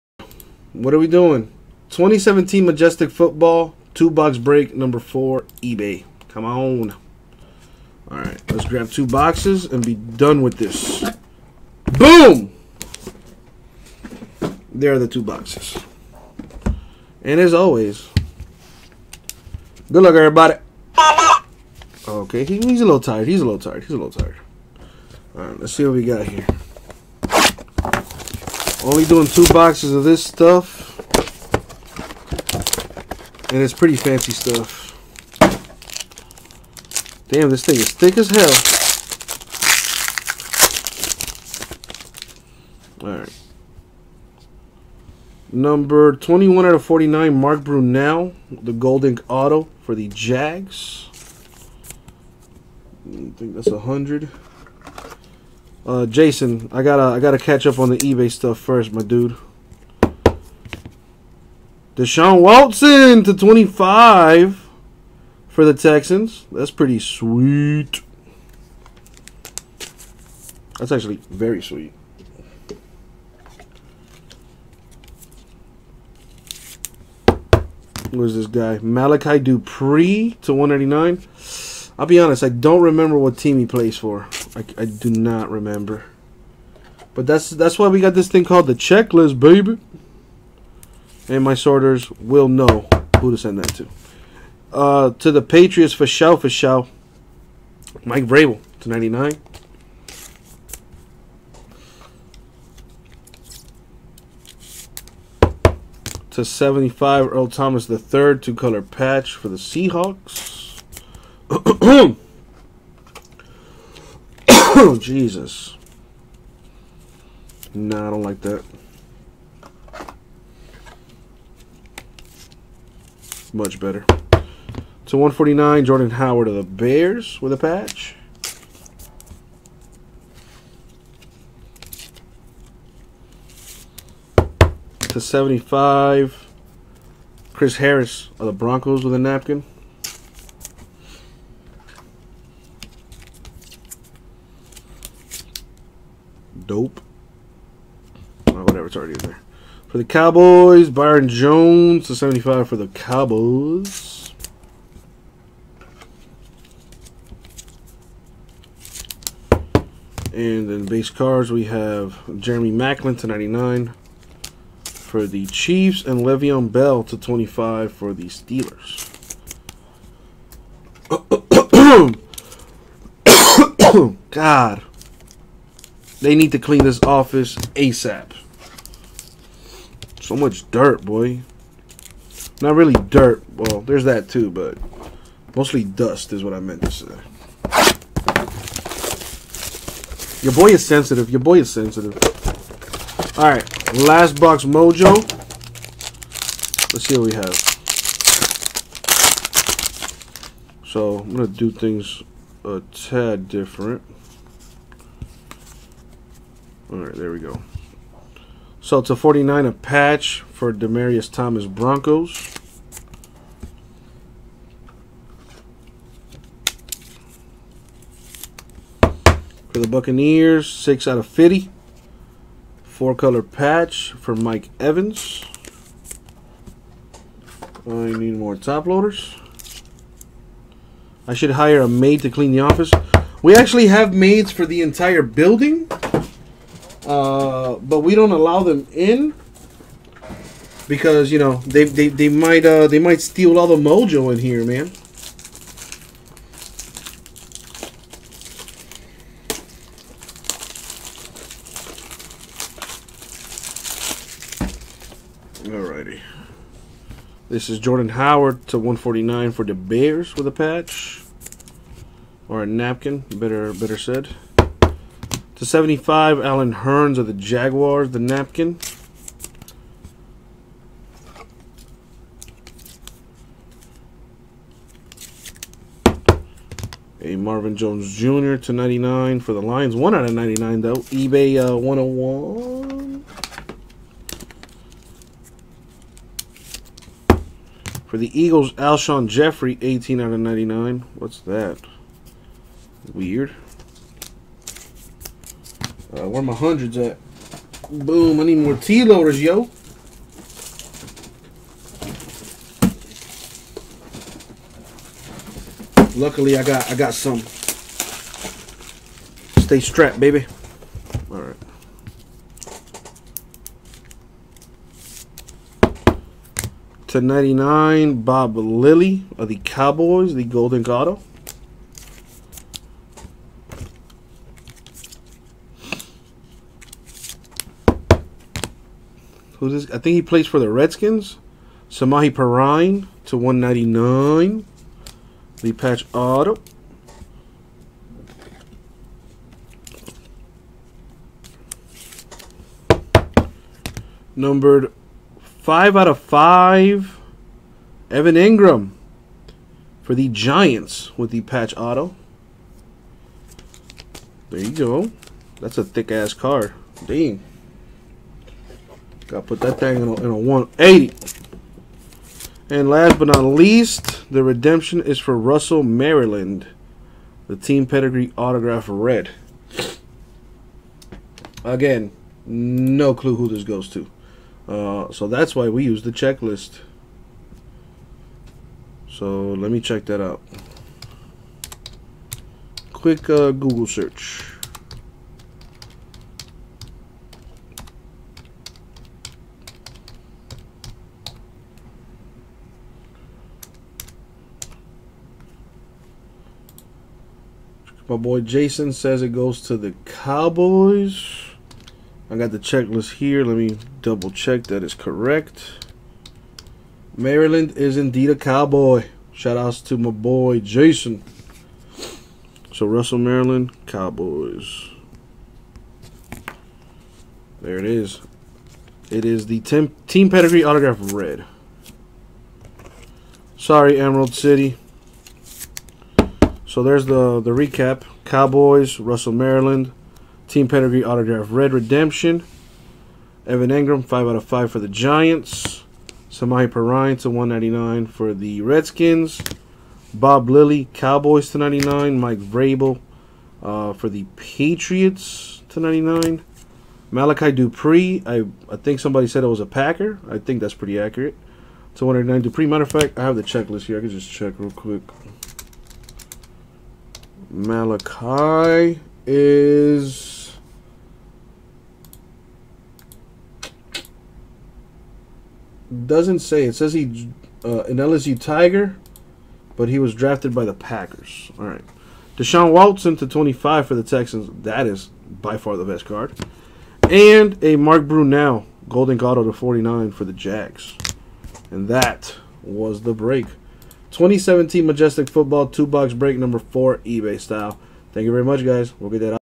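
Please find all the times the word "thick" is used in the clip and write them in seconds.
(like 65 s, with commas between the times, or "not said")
37 s, 355 s.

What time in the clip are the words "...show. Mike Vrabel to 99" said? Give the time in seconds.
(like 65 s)
96 s.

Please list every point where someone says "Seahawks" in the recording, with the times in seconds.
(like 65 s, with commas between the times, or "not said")
109 s.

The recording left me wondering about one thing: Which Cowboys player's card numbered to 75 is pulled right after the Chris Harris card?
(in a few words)
Byron Jones.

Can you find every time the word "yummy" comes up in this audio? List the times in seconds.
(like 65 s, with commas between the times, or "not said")
not said.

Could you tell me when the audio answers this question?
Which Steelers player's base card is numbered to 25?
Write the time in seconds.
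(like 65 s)
166 s.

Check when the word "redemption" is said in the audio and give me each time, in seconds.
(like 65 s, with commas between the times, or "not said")
364 s, 431 s.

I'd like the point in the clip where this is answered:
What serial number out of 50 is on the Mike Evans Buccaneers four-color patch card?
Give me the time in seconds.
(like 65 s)
220 s.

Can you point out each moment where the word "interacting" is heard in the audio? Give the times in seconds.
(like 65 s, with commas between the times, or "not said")
not said.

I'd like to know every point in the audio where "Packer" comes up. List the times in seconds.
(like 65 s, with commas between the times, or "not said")
449 s, 470 s.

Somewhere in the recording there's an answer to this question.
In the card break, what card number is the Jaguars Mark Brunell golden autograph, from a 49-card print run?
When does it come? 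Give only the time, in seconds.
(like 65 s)
45 s.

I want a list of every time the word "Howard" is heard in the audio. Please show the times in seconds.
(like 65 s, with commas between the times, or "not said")
126 s, 258 s.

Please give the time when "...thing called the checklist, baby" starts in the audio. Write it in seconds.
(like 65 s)
88 s.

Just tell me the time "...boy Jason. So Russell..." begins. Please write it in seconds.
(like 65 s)
410 s.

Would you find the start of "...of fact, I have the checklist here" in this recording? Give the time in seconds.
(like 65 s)
452 s.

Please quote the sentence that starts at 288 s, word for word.
For the Eagles, Alshon Jeffery, 18 out of 99.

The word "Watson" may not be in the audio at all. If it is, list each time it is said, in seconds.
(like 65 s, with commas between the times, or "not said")
62 s, 472 s.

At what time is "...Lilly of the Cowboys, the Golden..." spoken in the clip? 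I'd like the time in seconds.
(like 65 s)
318 s.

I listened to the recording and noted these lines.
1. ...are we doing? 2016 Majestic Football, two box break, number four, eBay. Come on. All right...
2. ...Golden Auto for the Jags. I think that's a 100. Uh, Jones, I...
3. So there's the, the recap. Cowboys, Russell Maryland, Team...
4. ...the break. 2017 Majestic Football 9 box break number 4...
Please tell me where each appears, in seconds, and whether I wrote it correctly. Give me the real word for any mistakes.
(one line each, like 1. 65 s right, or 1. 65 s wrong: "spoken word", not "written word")
1. 0 s wrong: "2017", not "2016"
2. 48 s wrong: "Jason", not "Jones"
3. 426 s right
4. 483 s wrong: "2", not "9".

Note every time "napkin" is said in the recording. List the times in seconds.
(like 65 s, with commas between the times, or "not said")
139 s, 262 s, 268 s.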